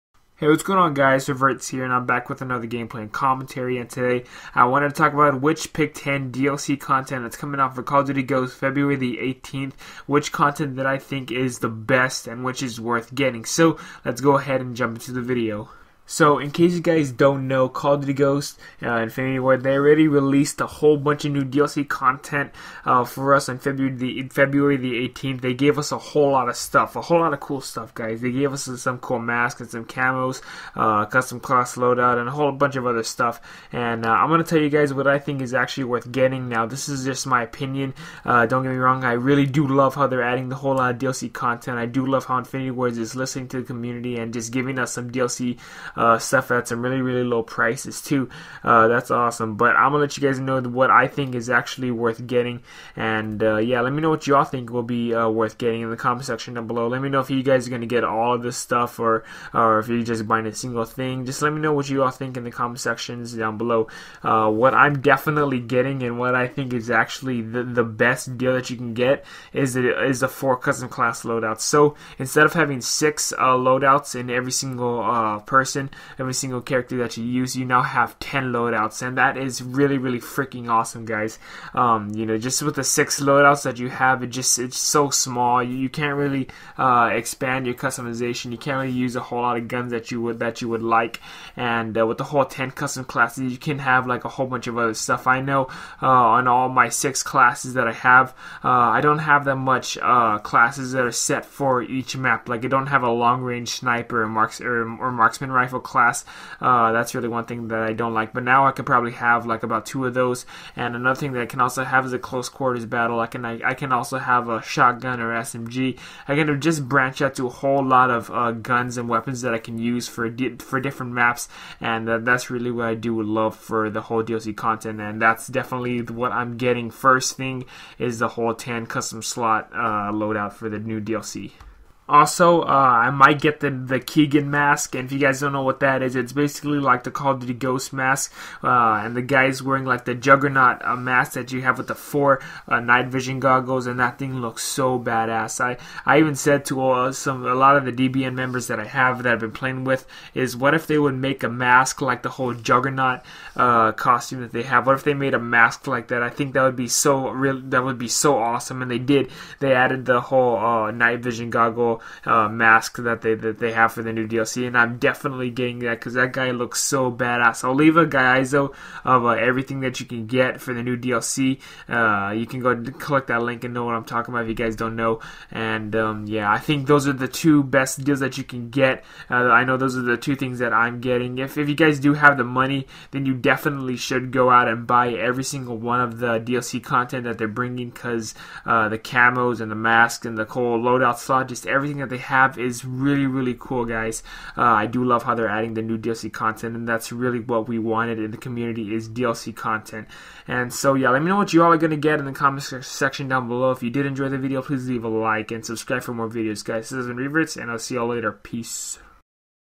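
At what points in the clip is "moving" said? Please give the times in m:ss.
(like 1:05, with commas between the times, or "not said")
not said.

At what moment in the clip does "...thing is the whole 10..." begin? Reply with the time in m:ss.
2:07.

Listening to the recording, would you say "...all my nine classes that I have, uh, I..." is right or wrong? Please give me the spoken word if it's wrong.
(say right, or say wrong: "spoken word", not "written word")
wrong: "six", not "nine".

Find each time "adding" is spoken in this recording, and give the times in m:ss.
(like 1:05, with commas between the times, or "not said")
0:40, 3:15.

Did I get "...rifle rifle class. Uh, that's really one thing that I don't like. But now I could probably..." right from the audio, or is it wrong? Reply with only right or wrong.
right.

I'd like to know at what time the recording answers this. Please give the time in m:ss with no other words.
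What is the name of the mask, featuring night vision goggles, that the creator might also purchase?
2:14.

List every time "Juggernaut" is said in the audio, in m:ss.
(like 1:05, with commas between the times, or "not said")
2:20, 2:32.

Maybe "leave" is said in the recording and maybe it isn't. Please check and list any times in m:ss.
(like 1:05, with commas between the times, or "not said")
2:47, 3:24.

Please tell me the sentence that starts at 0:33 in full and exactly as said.
And uh, I'm gonna tell you guys what I think is actually worth getting.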